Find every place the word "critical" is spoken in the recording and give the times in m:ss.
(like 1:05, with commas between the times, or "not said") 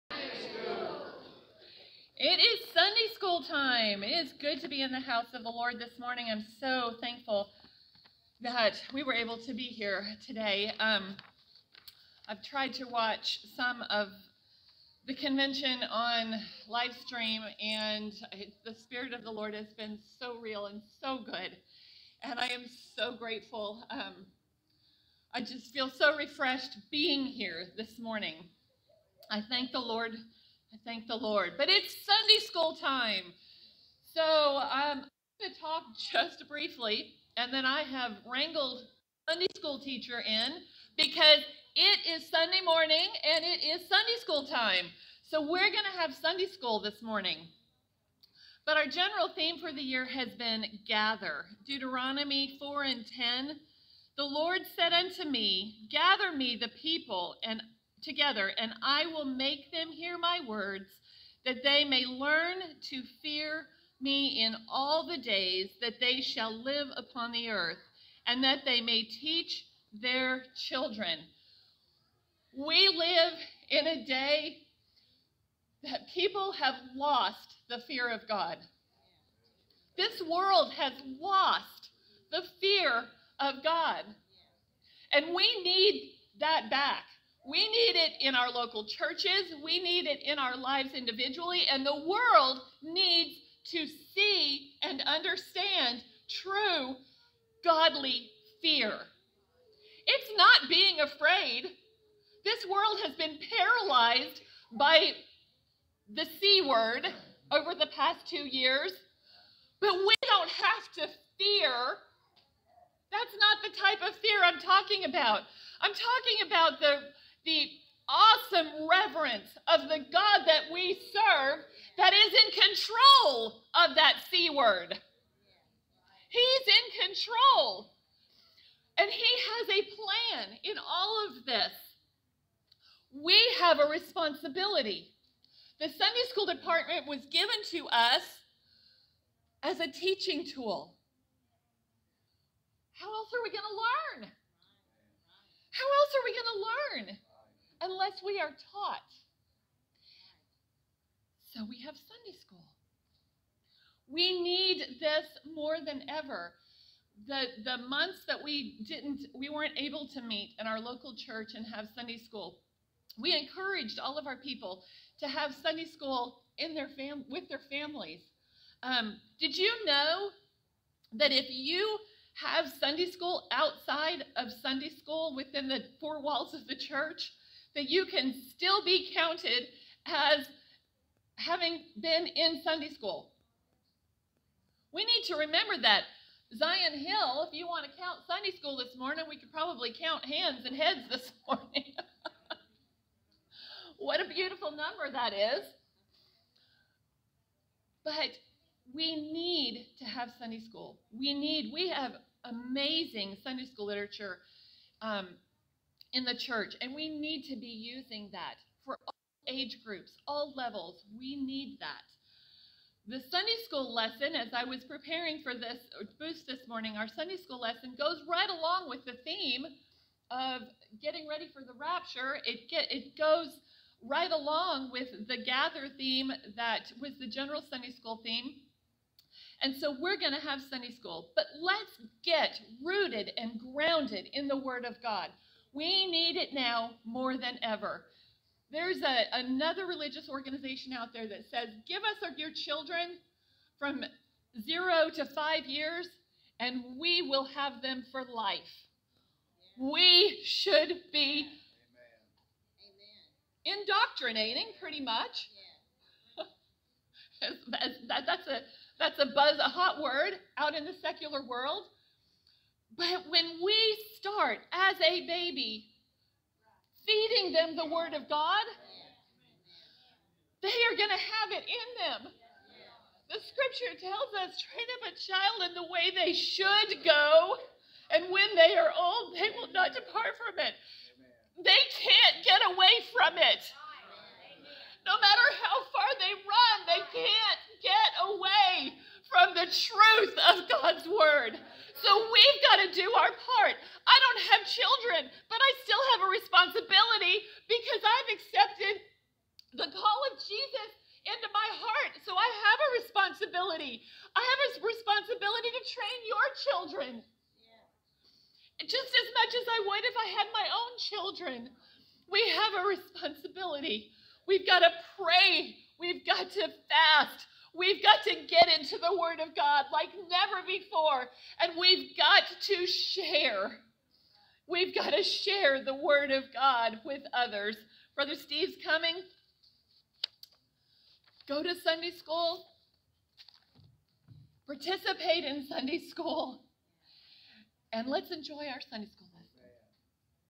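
not said.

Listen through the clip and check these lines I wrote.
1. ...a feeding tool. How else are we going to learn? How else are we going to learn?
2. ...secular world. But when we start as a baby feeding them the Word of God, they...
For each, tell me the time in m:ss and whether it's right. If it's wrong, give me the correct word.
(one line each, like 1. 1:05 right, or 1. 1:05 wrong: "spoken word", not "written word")
1. 2:19 wrong: "teaching", not "feeding"
2. 4:21 right.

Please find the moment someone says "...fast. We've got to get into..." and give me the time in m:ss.
5:16.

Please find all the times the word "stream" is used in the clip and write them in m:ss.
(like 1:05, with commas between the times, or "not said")
0:17.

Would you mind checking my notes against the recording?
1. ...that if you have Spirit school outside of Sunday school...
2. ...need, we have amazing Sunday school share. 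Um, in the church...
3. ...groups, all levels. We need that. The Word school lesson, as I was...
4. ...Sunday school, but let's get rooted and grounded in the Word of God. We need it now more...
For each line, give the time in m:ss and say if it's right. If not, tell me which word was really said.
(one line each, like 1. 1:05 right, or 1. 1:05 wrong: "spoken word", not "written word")
1. 2:51 wrong: "Sunday", not "Spirit"
2. 3:21 wrong: "literature", not "share"
3. 3:29 wrong: "Sunday", not "Word"
4. 3:50 right.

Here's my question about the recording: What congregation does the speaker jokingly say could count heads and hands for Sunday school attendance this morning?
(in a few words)
Zion Hill.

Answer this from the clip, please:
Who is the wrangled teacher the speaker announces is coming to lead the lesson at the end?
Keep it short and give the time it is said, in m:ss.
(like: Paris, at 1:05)
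Brother Steve, at 5:28.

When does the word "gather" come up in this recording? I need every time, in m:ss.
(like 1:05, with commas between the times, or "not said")
0:50, 0:55, 3:45.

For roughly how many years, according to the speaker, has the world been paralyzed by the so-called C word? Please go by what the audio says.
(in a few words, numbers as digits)
2 years.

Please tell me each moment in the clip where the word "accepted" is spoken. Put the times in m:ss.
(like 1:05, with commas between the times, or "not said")
4:58.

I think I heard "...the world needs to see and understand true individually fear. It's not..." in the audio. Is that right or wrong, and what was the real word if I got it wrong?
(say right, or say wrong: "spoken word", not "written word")
wrong: "godly", not "individually".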